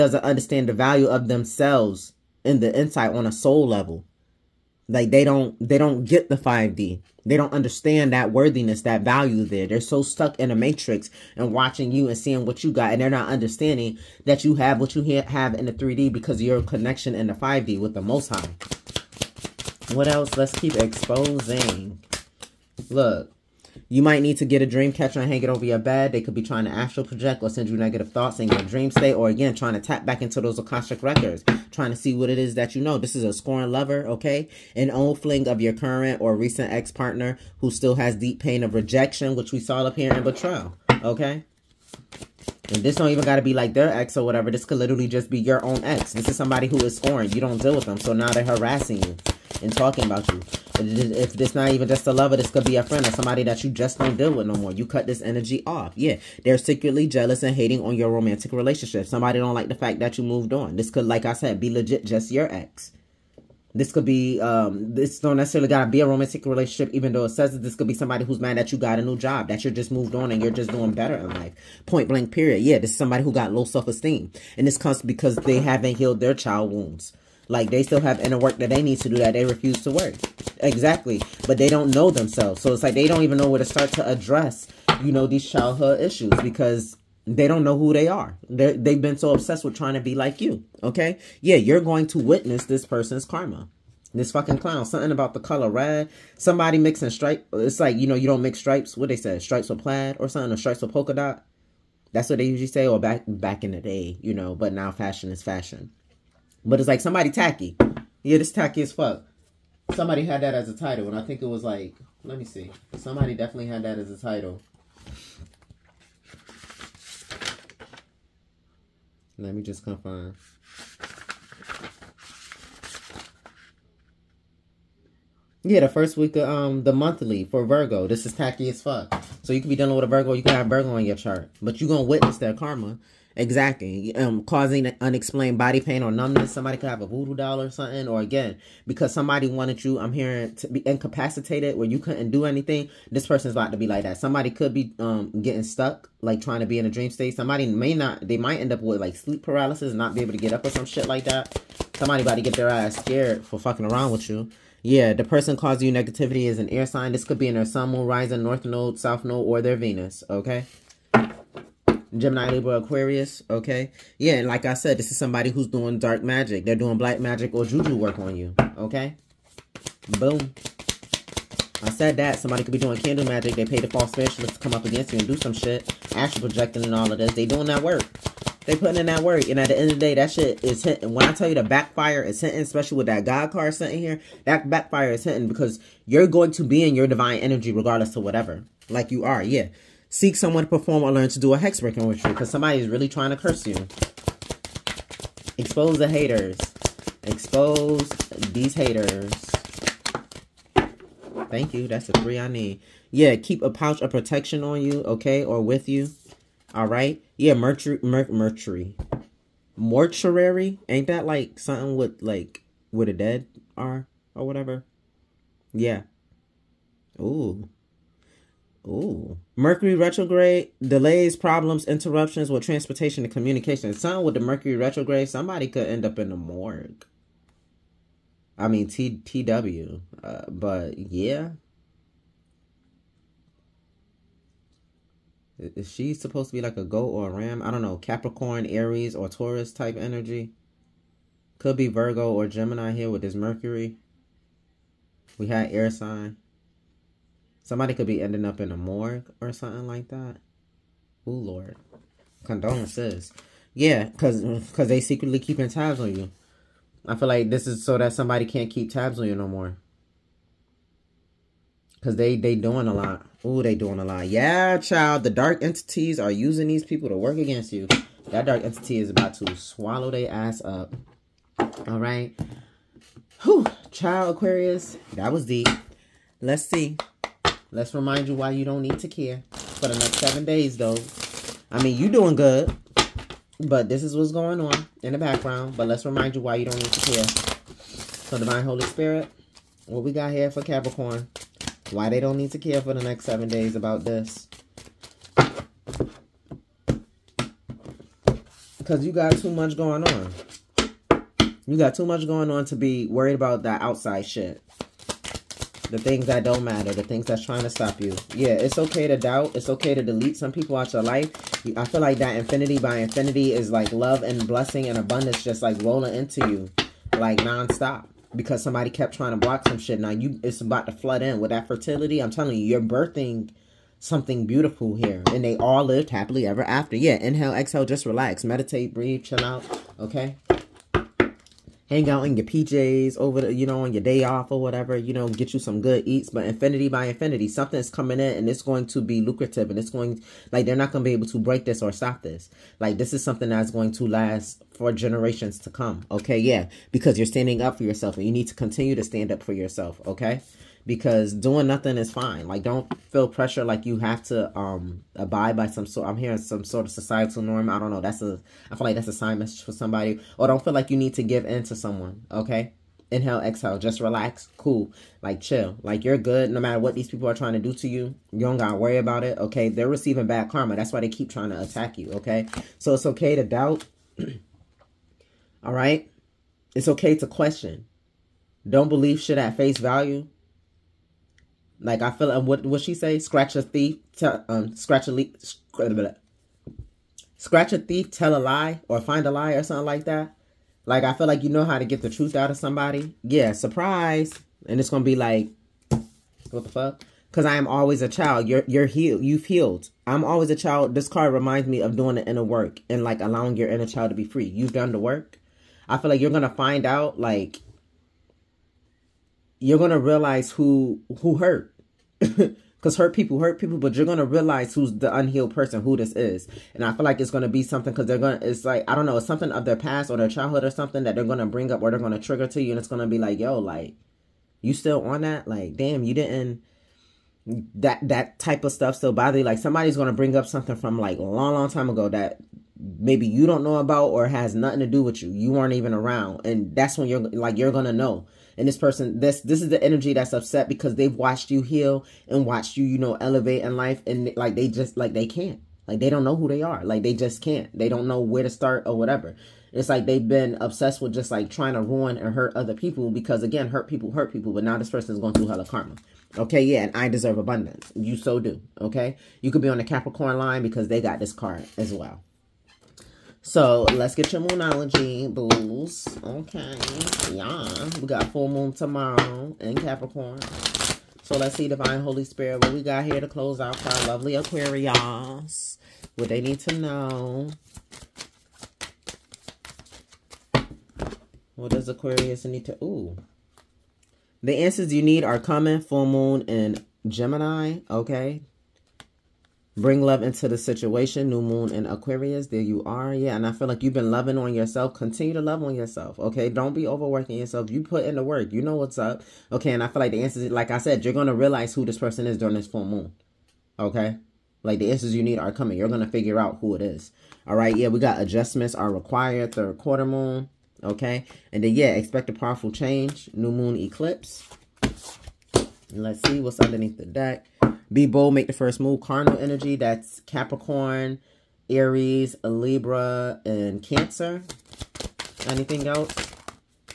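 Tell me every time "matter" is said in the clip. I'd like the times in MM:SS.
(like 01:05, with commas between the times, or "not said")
05:06, 06:06.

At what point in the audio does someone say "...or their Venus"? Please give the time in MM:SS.
02:39.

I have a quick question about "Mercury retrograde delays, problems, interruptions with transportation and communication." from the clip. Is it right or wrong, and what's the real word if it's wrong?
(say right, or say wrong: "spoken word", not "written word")
right.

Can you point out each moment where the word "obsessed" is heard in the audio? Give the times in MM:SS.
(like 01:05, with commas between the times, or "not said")
01:29, 07:30.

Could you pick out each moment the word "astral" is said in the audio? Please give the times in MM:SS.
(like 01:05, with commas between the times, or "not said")
00:26, 02:56.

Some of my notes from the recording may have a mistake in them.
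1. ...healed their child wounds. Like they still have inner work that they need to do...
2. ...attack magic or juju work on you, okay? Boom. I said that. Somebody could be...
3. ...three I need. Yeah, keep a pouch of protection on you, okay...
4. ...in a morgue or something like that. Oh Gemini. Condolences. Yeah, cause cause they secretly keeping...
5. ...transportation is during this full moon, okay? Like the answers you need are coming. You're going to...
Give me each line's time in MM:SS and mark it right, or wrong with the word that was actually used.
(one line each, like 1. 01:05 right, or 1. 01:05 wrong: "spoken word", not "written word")
1. 01:15 right
2. 02:46 wrong: "black", not "attack"
3. 03:22 right
4. 04:08 wrong: "Lord", not "Gemini"
5. 08:21 wrong: "person", not "transportation".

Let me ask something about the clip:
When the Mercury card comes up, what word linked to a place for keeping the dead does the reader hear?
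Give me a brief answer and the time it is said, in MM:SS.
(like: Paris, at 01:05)
mortuary, at 03:29.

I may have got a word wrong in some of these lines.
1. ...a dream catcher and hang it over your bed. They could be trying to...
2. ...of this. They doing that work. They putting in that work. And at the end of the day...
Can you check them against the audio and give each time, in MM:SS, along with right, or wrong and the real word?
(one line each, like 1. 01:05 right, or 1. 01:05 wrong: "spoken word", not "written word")
1. 00:24 right
2. 02:57 right.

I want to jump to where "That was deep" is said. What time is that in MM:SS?
04:35.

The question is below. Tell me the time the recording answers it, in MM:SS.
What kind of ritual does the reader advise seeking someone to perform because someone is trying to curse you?
03:11.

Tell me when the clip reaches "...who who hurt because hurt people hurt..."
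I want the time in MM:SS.
06:50.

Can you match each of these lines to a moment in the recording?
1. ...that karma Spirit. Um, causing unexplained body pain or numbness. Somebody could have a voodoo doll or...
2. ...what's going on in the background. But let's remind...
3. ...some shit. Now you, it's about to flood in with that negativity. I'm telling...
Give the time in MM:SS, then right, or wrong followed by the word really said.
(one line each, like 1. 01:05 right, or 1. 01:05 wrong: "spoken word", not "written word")
1. 02:12 wrong: "Exactly", not "Spirit"
2. 04:44 right
3. 05:19 wrong: "fertility", not "negativity".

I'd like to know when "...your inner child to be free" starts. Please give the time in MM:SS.
06:43.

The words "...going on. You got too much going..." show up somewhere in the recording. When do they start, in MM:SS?
04:59.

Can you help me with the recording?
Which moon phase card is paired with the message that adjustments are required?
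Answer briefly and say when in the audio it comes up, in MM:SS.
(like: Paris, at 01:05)
third quarter moon, at 08:29.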